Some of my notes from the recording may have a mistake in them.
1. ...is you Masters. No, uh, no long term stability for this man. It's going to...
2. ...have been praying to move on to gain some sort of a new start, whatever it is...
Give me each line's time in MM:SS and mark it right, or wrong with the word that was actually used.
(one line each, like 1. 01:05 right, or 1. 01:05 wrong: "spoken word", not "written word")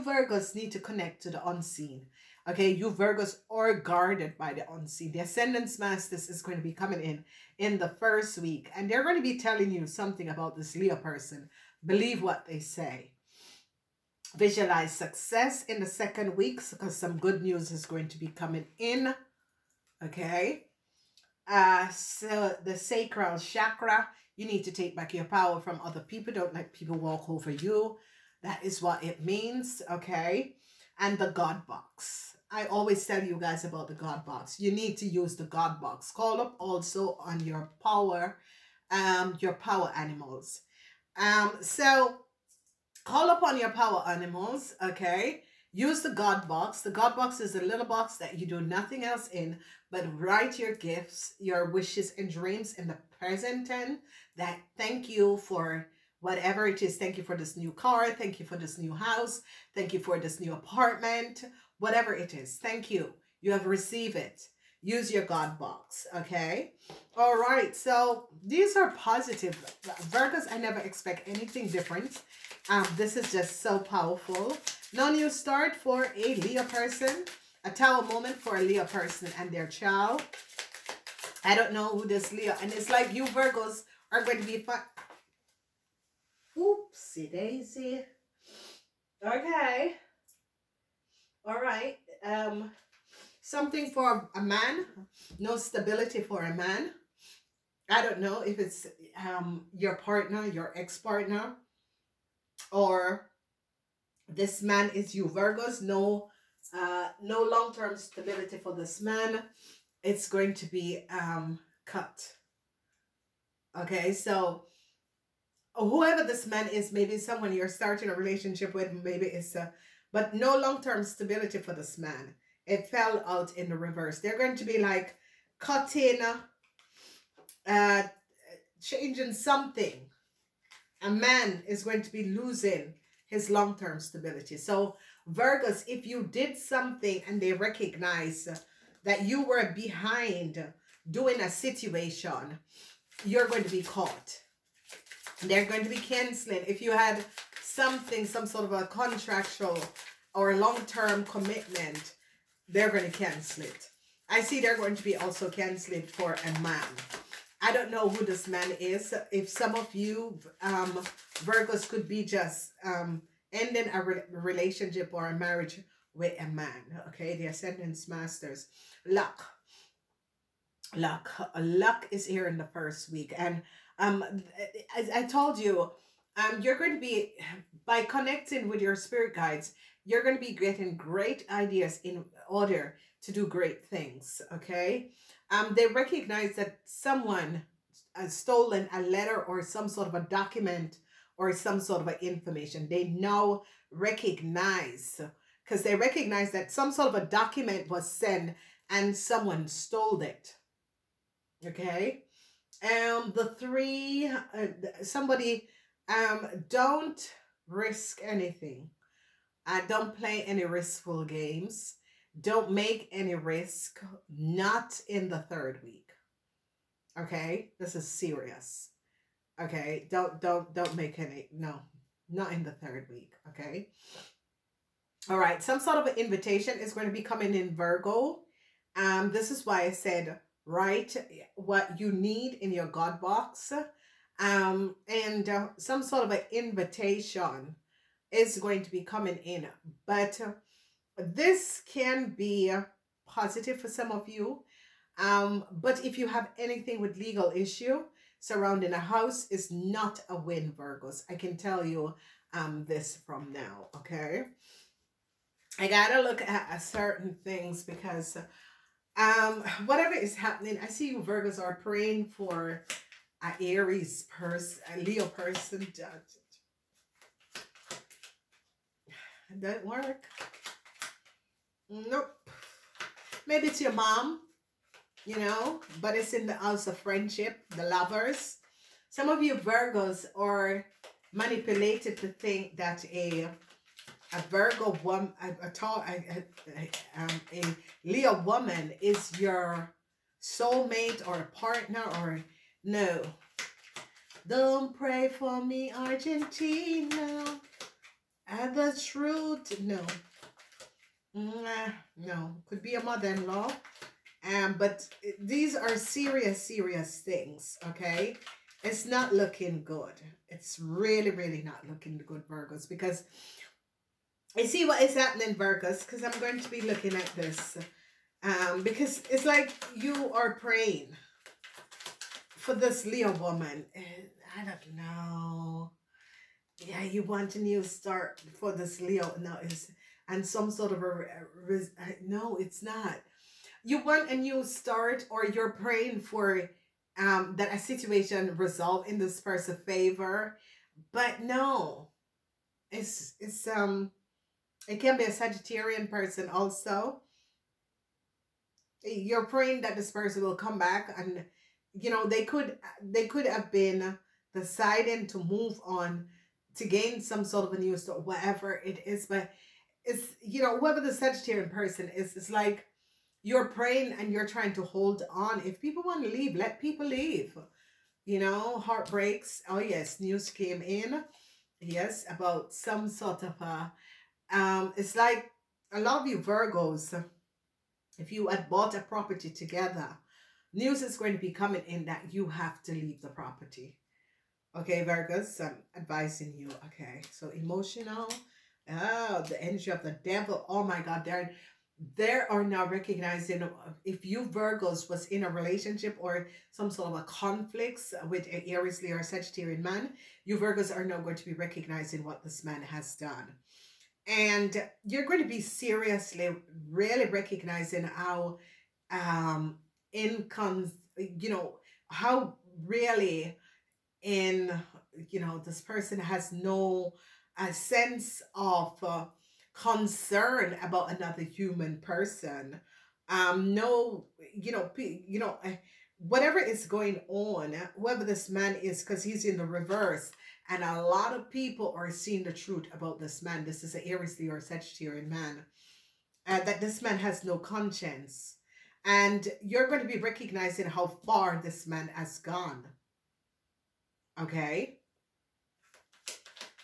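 1. 01:44 wrong: "Virgos", not "Masters"
2. 05:53 wrong: "deciding", not "praying".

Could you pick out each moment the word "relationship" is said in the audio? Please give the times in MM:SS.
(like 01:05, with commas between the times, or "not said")
01:58, 02:44, 06:35.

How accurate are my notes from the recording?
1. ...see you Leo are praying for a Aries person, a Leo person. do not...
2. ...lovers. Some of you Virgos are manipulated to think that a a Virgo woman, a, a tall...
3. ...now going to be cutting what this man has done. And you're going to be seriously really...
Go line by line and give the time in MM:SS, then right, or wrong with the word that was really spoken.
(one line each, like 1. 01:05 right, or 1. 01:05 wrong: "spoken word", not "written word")
1. 04:20 wrong: "Virgos", not "Leo"
2. 04:37 right
3. 06:41 wrong: "recognizing", not "cutting".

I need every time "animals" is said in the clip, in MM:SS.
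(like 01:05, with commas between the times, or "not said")
00:39, 00:44.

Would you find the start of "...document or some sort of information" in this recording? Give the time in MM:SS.
03:10.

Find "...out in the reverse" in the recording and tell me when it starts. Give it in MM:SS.
02:03.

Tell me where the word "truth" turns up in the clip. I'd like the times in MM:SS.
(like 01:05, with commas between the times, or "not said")
04:58, 07:12.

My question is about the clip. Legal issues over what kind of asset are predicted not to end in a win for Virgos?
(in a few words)
A house.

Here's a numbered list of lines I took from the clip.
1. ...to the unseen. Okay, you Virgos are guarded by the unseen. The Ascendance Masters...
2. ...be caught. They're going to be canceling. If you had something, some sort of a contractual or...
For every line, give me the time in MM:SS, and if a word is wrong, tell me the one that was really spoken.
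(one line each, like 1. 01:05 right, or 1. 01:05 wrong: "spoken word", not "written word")
1. 00:01 right
2. 02:23 right.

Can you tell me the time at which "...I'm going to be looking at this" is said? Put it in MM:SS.
05:16.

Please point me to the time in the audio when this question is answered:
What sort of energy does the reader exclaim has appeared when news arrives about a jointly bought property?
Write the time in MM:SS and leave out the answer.
06:30.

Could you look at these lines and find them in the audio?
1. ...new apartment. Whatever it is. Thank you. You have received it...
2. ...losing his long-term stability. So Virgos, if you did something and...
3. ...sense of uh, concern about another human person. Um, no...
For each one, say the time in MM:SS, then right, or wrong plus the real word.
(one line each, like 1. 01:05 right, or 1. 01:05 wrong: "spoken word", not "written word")
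1. 01:00 right
2. 02:12 right
3. 06:57 right.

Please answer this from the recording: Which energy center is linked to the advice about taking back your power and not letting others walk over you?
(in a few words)
Sacral chakra.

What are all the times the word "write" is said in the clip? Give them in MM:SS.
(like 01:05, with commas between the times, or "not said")
00:50, 03:50.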